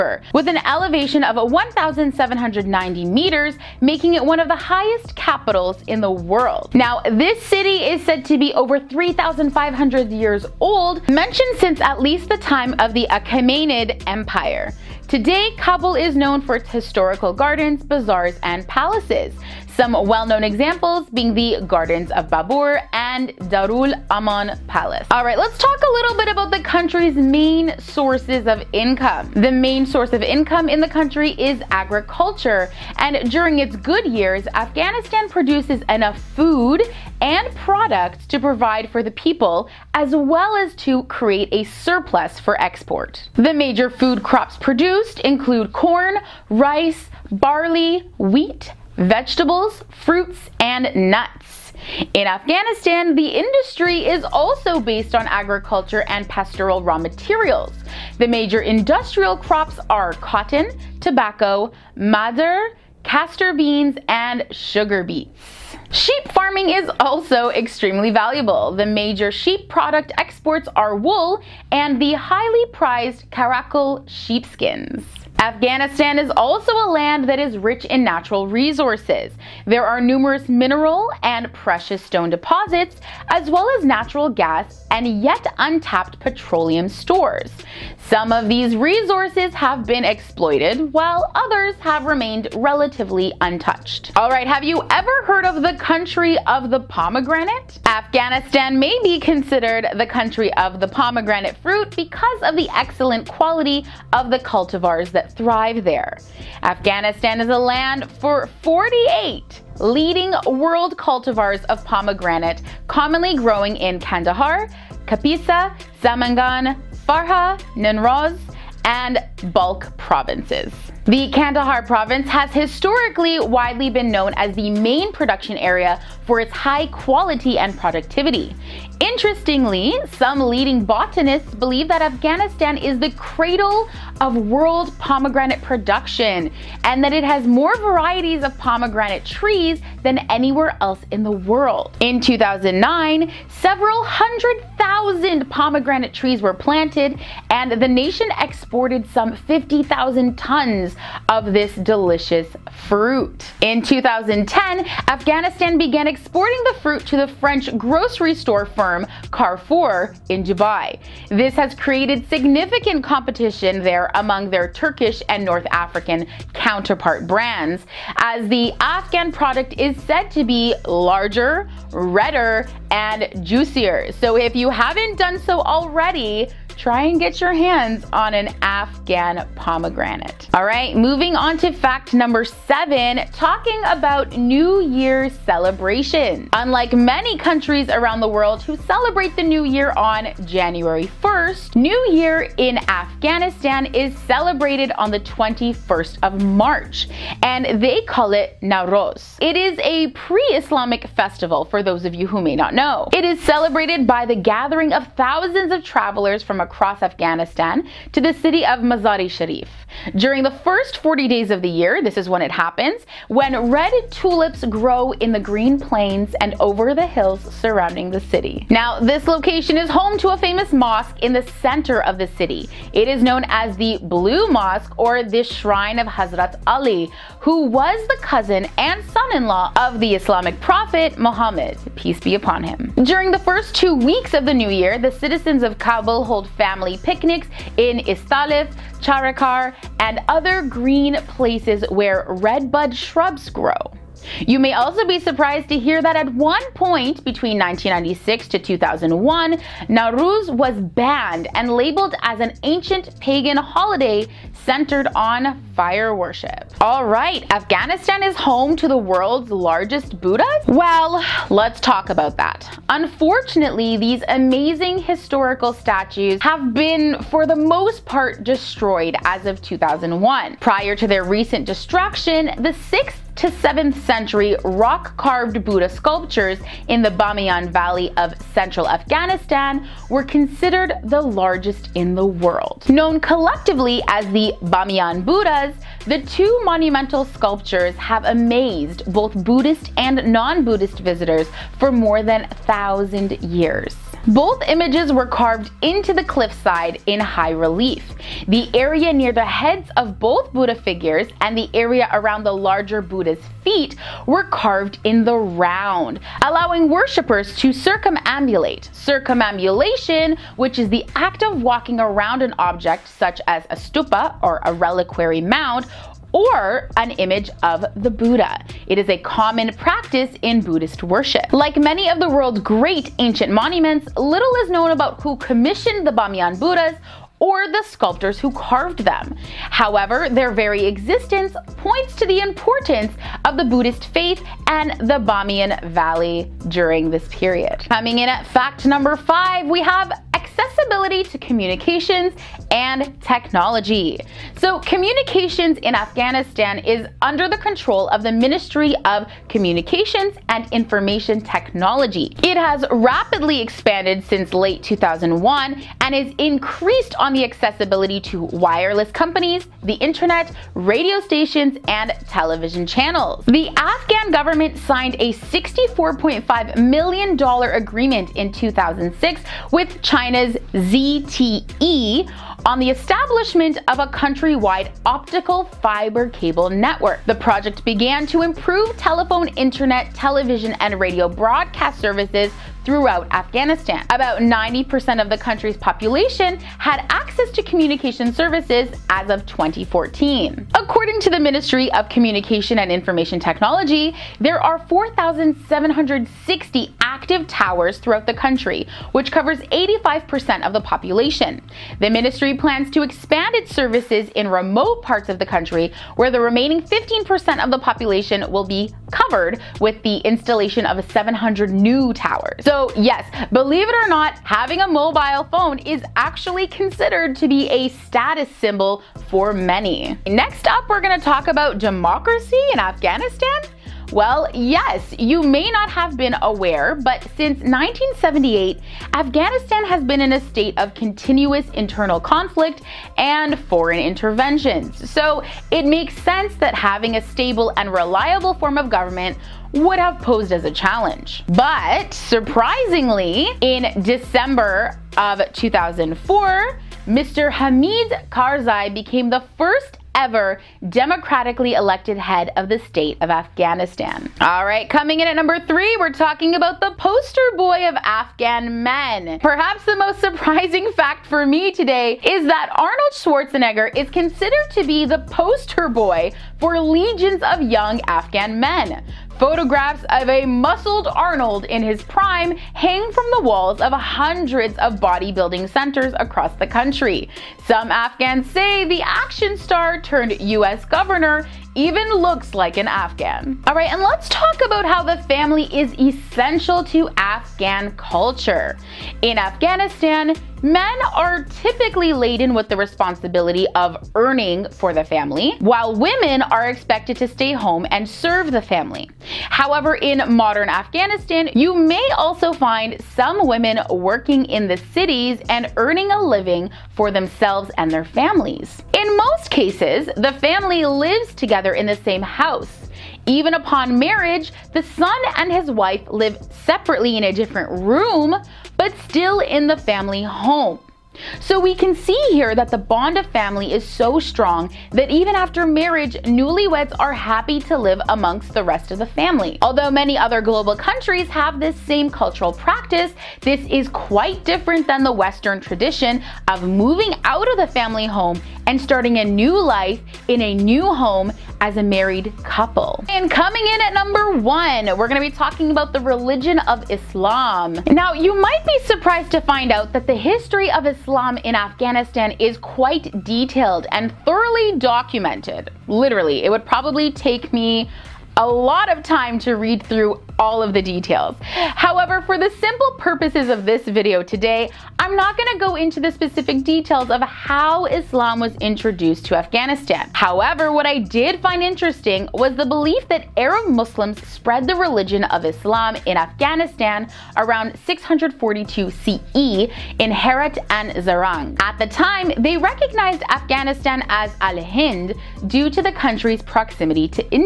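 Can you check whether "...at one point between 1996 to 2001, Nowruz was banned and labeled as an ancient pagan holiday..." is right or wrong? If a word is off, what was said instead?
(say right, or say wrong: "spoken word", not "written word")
right.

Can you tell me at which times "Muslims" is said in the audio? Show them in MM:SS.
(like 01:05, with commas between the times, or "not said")
09:33.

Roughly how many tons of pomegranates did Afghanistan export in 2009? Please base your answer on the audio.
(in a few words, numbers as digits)
50,000 tons.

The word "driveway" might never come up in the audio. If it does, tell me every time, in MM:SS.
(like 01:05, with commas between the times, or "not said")
not said.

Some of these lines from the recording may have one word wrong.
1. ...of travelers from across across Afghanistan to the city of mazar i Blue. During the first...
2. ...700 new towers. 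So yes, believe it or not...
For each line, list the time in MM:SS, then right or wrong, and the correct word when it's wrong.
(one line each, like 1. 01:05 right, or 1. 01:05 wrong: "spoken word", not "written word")
1. 03:25 wrong: "Sharif", not "Blue"
2. 06:51 right.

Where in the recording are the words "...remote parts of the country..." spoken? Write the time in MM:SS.
06:44.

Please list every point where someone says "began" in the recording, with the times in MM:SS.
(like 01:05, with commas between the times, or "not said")
02:35, 06:17.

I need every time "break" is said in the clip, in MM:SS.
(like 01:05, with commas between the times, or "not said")
not said.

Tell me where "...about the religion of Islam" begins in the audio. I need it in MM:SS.
09:05.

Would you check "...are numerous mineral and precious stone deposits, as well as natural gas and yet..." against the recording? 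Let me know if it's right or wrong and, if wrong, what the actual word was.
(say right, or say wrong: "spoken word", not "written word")
right.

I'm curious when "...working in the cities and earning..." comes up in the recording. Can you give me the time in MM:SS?
08:23.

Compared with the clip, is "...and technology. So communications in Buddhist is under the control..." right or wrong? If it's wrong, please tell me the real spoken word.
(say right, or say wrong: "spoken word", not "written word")
wrong: "Afghanistan", not "Buddhist".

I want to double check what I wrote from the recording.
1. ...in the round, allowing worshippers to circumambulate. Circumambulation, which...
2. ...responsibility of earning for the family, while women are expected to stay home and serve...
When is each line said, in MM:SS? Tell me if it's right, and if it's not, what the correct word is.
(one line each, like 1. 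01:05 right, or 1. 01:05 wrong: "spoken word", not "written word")
1. 05:05 right
2. 08:12 right.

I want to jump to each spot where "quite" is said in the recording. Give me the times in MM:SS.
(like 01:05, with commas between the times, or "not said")
08:53, 09:12.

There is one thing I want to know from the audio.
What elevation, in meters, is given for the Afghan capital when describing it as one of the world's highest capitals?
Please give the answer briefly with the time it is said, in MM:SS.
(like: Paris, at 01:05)
1,790 meters, at 00:01.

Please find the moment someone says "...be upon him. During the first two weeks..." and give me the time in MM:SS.
03:52.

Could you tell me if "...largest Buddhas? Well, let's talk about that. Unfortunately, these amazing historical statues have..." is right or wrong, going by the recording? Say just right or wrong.
right.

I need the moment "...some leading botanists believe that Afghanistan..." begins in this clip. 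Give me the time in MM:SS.
02:10.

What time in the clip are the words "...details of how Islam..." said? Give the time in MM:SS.
09:26.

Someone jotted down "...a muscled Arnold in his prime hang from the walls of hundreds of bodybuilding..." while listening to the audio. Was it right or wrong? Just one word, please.
right.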